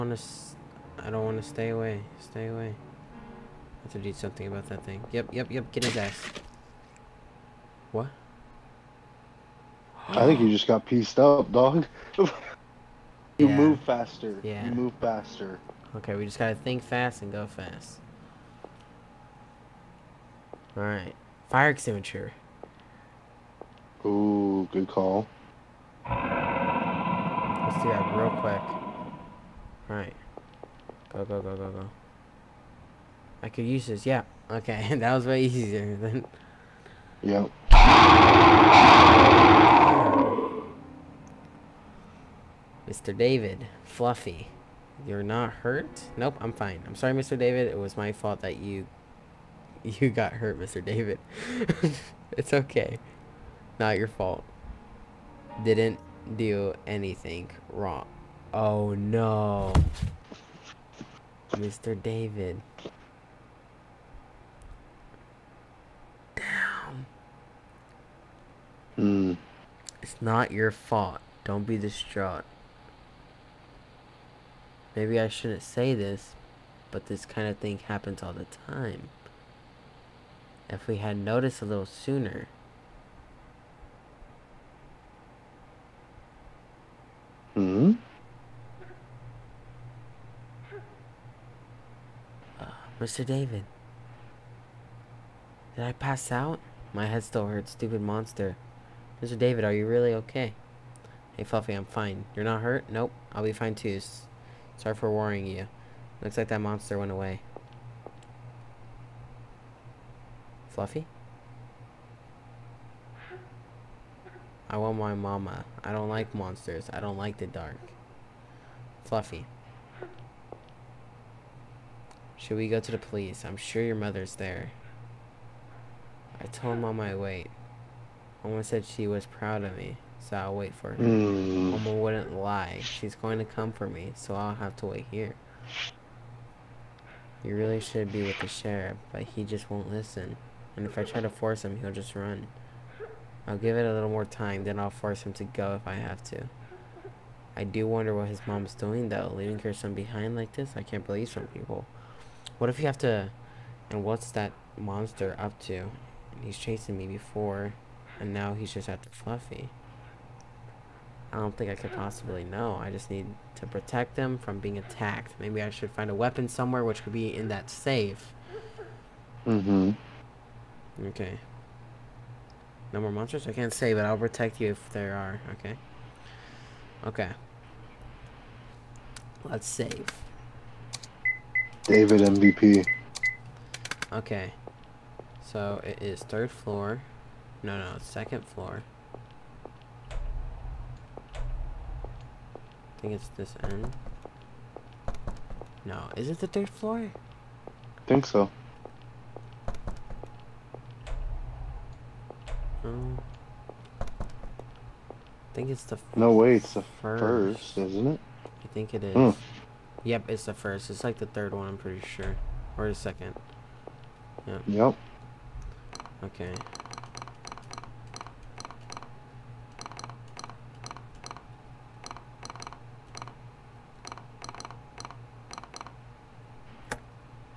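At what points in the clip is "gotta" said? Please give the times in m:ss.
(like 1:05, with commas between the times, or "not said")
0:16.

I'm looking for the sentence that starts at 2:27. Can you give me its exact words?
I do wonder what his mom's doing, though.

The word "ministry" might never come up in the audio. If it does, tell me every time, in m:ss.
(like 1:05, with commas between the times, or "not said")
not said.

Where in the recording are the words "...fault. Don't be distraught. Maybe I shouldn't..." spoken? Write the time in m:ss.
1:10.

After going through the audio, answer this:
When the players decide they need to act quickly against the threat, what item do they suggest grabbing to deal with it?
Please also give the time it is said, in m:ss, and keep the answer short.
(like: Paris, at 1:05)
Fire extinguisher, at 0:21.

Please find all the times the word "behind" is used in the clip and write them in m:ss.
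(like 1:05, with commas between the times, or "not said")
2:29.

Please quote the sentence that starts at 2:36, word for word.
He's chasing me before, and now he's just after Fluffy.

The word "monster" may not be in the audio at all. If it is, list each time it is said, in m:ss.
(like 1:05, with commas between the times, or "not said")
1:38, 1:46, 1:56, 2:34, 2:53.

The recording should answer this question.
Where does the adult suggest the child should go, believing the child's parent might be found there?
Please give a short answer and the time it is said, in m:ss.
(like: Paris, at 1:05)
The police, at 2:02.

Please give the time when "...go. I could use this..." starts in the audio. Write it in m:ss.
0:31.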